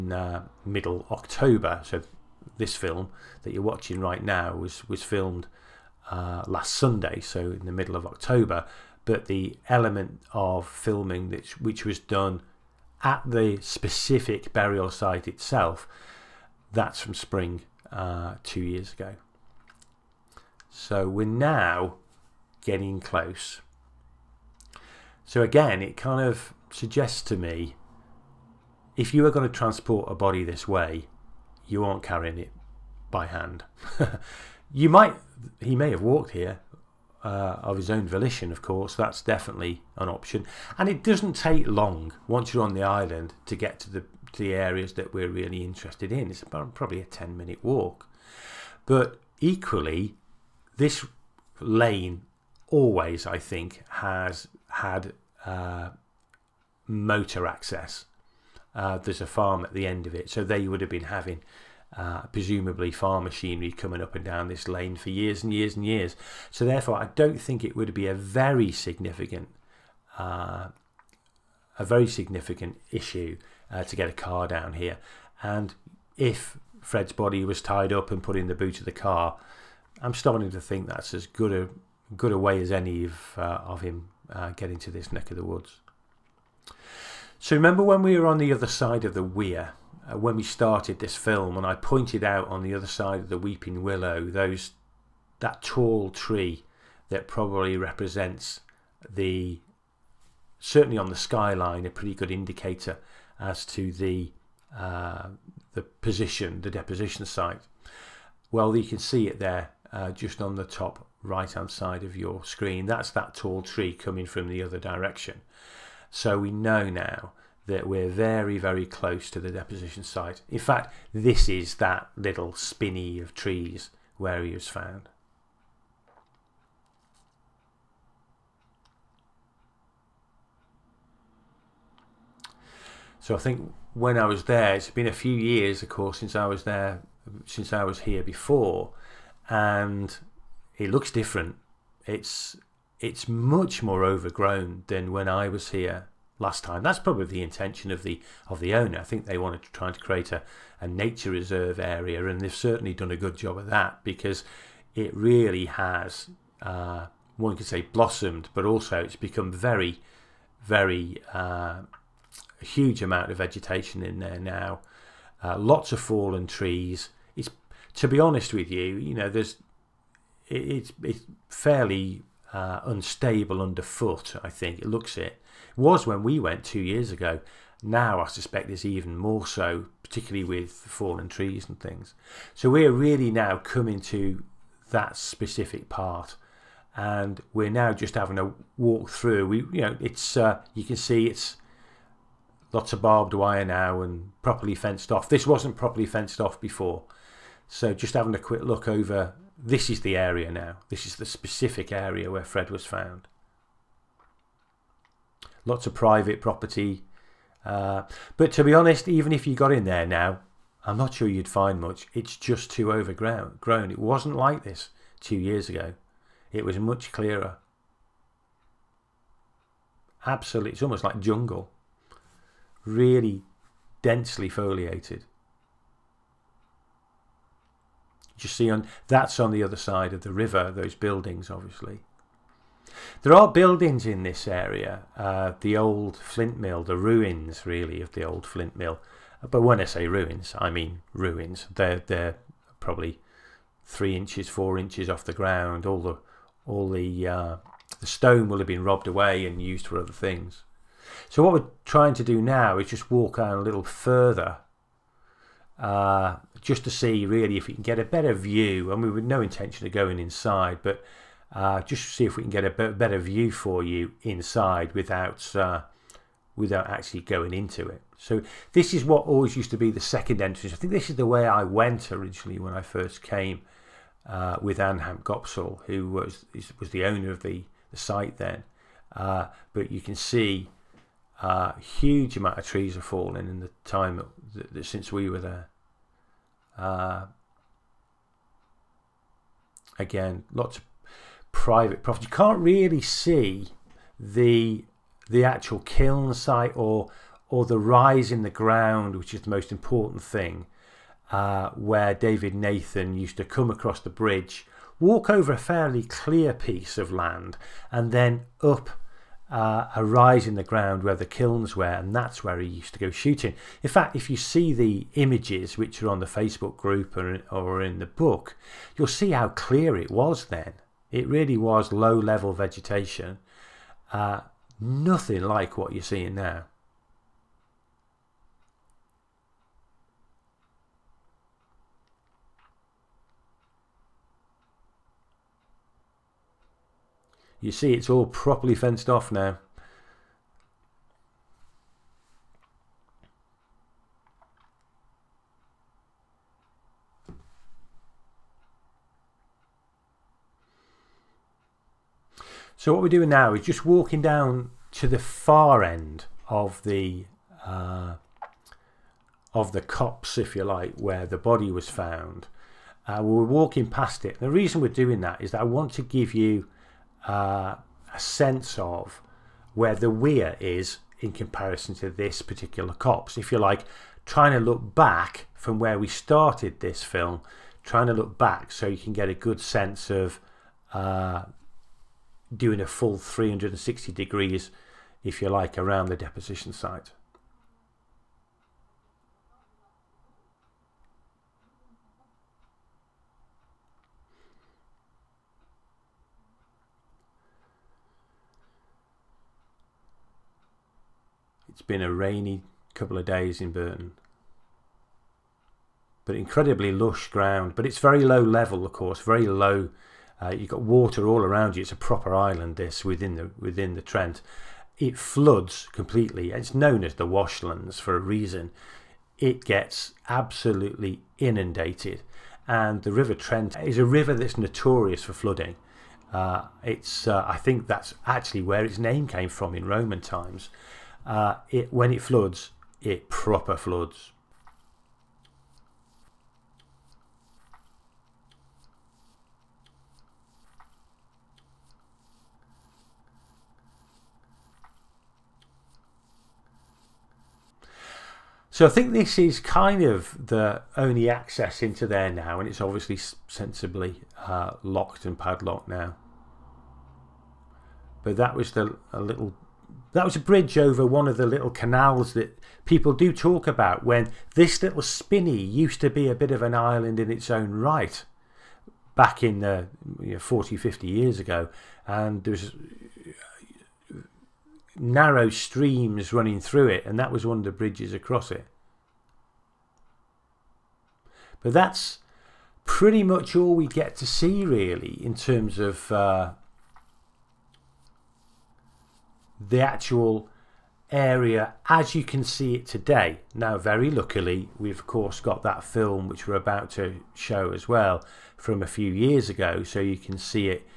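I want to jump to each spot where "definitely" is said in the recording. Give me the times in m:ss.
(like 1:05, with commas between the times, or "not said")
0:39.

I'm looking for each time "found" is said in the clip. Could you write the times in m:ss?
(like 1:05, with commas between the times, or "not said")
2:04, 3:22, 6:01.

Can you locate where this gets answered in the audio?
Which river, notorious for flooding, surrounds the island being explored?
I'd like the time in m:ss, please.
7:03.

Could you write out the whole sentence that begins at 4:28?
So this is what always used to be the second entrance.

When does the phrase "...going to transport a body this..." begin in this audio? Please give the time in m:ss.
0:29.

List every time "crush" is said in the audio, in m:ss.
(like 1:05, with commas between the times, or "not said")
not said.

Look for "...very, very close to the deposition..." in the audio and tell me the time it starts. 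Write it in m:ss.
1:58.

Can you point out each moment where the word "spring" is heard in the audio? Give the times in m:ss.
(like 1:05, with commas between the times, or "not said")
0:17.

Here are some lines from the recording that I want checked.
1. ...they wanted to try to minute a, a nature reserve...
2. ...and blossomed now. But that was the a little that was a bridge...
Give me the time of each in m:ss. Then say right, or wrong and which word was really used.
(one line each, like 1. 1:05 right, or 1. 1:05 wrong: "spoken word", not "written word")
1. 2:29 wrong: "create", not "minute"
2. 7:35 wrong: "padlocked", not "blossomed".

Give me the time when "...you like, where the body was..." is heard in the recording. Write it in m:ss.
6:00.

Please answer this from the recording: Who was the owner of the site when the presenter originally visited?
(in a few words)
Anham Gopsal.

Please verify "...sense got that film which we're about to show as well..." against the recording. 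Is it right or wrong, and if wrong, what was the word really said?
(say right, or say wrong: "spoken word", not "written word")
wrong: "course", not "sense".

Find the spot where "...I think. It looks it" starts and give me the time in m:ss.
2:54.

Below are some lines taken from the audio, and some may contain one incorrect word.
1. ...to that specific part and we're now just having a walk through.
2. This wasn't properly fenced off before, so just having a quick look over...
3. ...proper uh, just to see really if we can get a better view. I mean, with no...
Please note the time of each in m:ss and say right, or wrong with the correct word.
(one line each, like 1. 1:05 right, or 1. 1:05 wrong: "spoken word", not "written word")
1. 3:04 right
2. 3:15 right
3. 4:13 wrong: "further", not "proper".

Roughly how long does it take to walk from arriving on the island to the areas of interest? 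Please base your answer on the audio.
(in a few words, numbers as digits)
10 minutes.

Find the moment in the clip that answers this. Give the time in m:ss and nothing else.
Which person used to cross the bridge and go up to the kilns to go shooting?
5:02.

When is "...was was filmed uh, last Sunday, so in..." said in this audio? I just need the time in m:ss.
0:04.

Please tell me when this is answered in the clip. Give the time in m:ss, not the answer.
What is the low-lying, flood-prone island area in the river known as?
6:57.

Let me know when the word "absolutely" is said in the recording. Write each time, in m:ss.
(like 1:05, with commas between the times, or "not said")
3:40, 7:00.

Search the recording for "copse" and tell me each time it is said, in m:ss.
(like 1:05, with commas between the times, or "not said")
5:59, 6:12.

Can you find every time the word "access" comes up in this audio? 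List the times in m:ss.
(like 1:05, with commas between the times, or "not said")
0:57, 7:31.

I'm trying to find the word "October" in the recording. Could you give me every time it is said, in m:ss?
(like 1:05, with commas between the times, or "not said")
0:01, 0:08.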